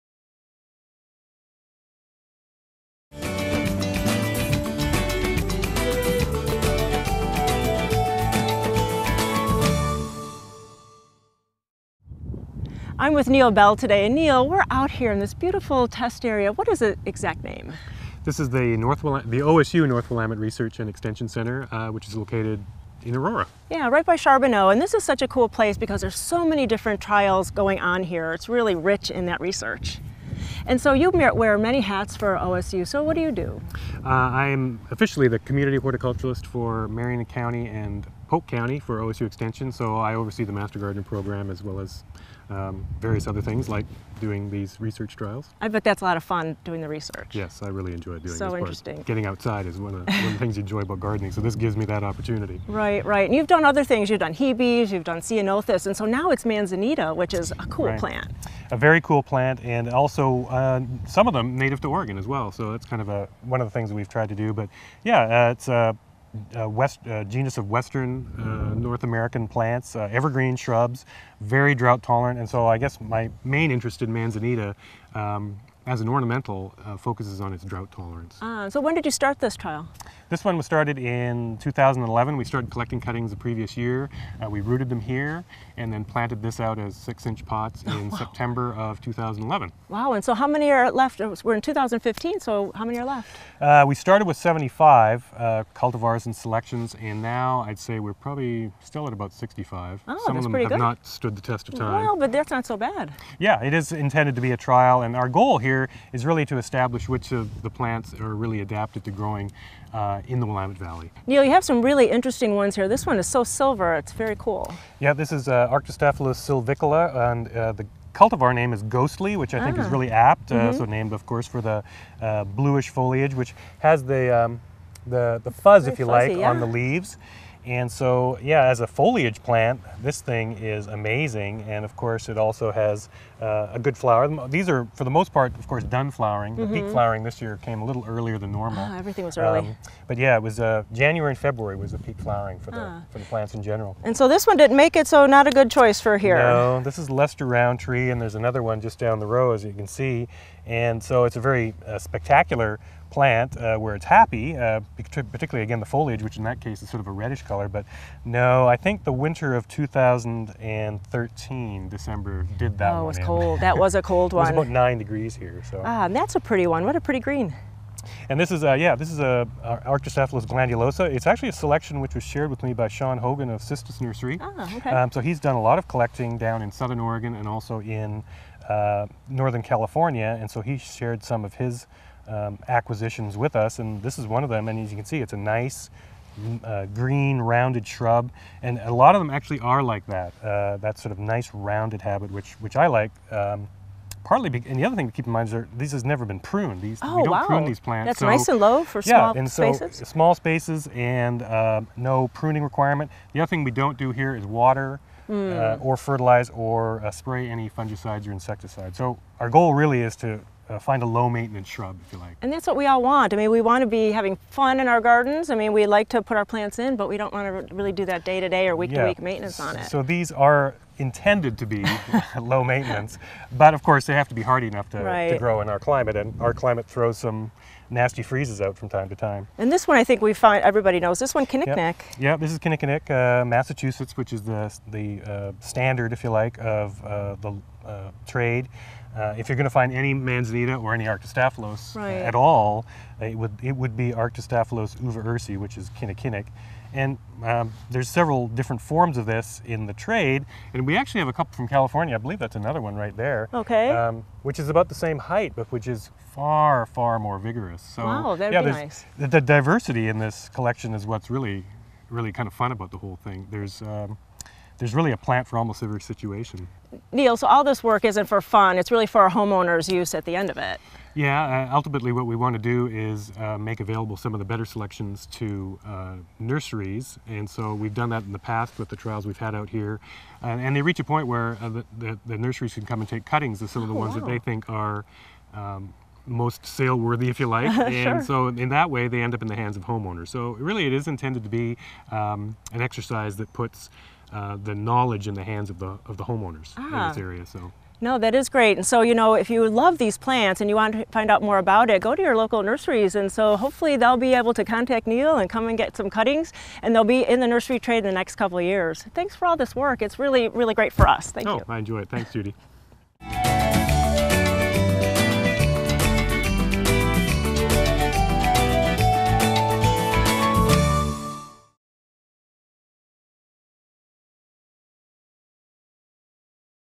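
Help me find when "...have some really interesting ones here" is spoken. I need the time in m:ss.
1:51.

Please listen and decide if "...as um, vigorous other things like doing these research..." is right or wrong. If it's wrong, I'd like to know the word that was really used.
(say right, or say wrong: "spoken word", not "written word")
wrong: "various", not "vigorous".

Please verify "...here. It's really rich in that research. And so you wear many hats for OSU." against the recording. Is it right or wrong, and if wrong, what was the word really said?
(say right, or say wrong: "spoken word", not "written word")
right.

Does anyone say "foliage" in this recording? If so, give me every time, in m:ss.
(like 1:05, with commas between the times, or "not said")
2:02, 2:08, 2:35.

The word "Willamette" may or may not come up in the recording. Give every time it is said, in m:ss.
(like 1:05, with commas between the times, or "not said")
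0:20, 1:50.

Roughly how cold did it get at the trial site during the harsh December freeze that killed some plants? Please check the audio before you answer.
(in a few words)
9 degrees.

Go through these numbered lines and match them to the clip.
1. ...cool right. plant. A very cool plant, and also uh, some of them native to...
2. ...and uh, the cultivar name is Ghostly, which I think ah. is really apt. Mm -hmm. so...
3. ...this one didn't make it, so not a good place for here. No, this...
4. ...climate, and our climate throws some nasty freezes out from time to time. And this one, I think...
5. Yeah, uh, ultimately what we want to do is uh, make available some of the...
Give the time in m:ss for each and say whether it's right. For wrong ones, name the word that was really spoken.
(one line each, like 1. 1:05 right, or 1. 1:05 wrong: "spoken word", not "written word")
1. 0:57 right
2. 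1:57 right
3. 2:24 wrong: "choice", not "place"
4. 3:45 right
5. 4:31 right.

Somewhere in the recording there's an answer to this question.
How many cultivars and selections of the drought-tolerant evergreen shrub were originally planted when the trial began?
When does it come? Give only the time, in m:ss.
1:34.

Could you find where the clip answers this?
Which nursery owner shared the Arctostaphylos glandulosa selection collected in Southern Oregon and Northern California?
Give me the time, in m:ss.
2:52.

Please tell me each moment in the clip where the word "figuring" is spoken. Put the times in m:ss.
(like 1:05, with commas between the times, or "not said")
not said.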